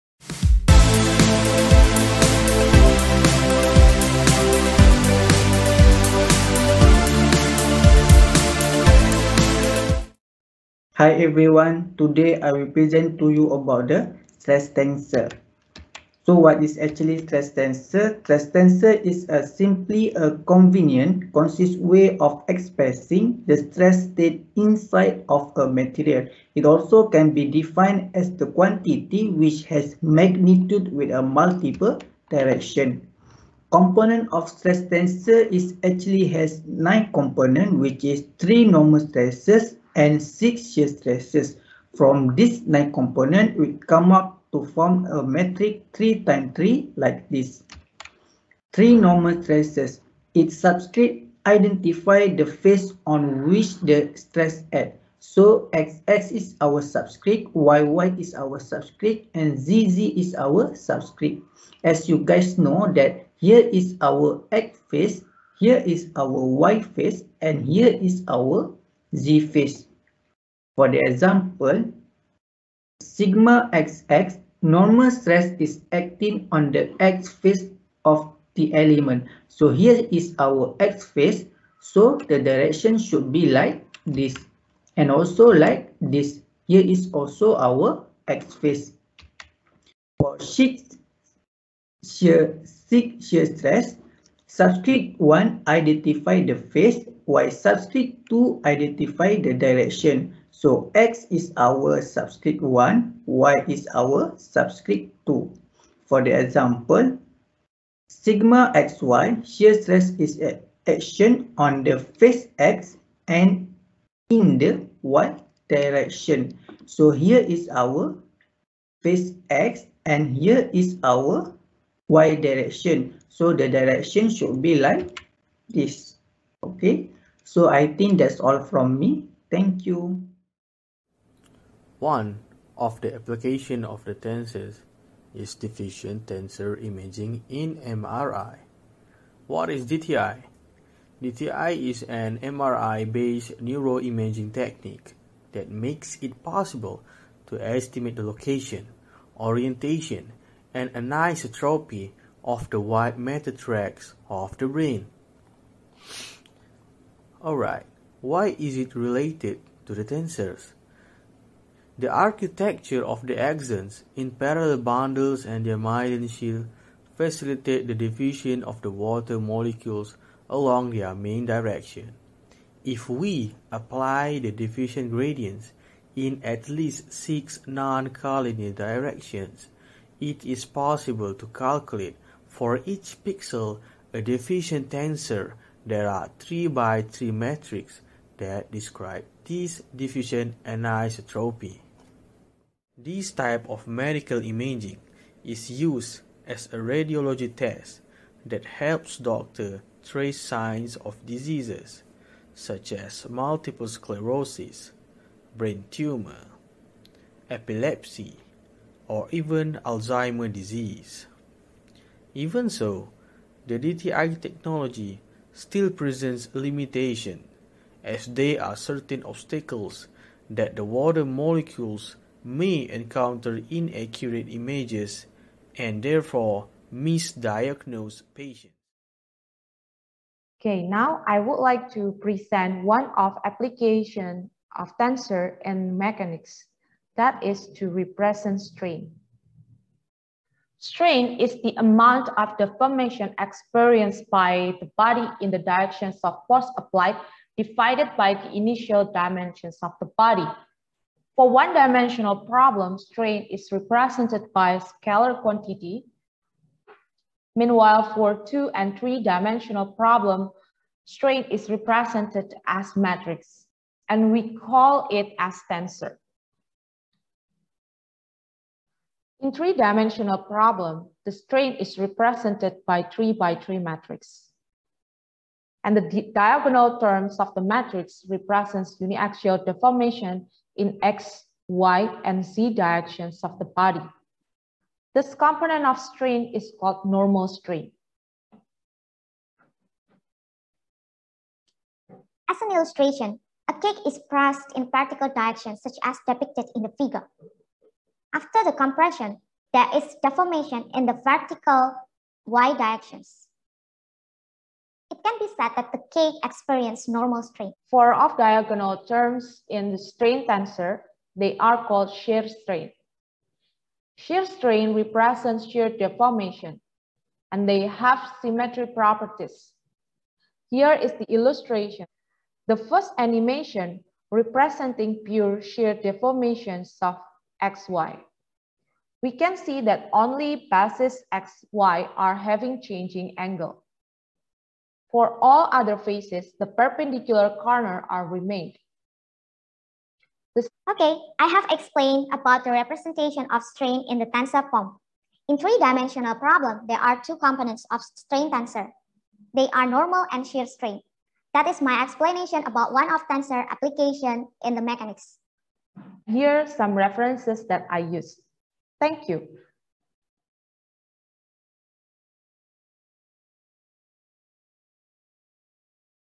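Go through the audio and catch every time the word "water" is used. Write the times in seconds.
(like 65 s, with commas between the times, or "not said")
168 s, 220 s.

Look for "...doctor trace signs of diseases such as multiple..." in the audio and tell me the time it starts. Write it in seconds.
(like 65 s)
199 s.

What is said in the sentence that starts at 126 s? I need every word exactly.
Okay, so I think that's all from me.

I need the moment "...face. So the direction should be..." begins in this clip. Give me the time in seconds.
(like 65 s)
81 s.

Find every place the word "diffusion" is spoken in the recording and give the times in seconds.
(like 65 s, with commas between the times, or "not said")
135 s, 167 s, 174 s, 184 s, 189 s.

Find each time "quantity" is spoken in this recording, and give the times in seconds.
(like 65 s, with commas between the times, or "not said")
28 s, 255 s.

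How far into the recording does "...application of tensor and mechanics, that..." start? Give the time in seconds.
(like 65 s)
233 s.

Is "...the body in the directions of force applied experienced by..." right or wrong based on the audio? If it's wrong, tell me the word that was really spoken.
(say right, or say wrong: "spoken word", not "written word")
wrong: "divided", not "experienced".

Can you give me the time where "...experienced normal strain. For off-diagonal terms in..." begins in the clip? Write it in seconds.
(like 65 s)
306 s.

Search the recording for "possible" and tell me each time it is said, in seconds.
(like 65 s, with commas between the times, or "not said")
146 s, 180 s.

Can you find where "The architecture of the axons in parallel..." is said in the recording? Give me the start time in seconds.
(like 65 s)
161 s.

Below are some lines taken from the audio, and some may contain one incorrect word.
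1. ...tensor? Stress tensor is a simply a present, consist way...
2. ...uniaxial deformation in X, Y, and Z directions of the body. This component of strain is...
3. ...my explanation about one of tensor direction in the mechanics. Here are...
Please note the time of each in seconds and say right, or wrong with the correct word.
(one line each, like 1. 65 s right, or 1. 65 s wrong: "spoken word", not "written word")
1. 17 s wrong: "convenient", not "present"
2. 279 s right
3. 351 s wrong: "application", not "direction".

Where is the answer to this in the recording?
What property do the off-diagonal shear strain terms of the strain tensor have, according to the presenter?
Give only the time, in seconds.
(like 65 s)
318 s.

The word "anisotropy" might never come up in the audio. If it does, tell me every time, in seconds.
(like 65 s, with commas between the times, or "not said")
150 s, 190 s.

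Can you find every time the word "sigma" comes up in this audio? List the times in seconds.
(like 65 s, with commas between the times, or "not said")
73 s, 108 s.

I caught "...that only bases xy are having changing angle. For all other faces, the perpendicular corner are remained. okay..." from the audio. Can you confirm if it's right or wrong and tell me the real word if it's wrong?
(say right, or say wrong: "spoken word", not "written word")
right.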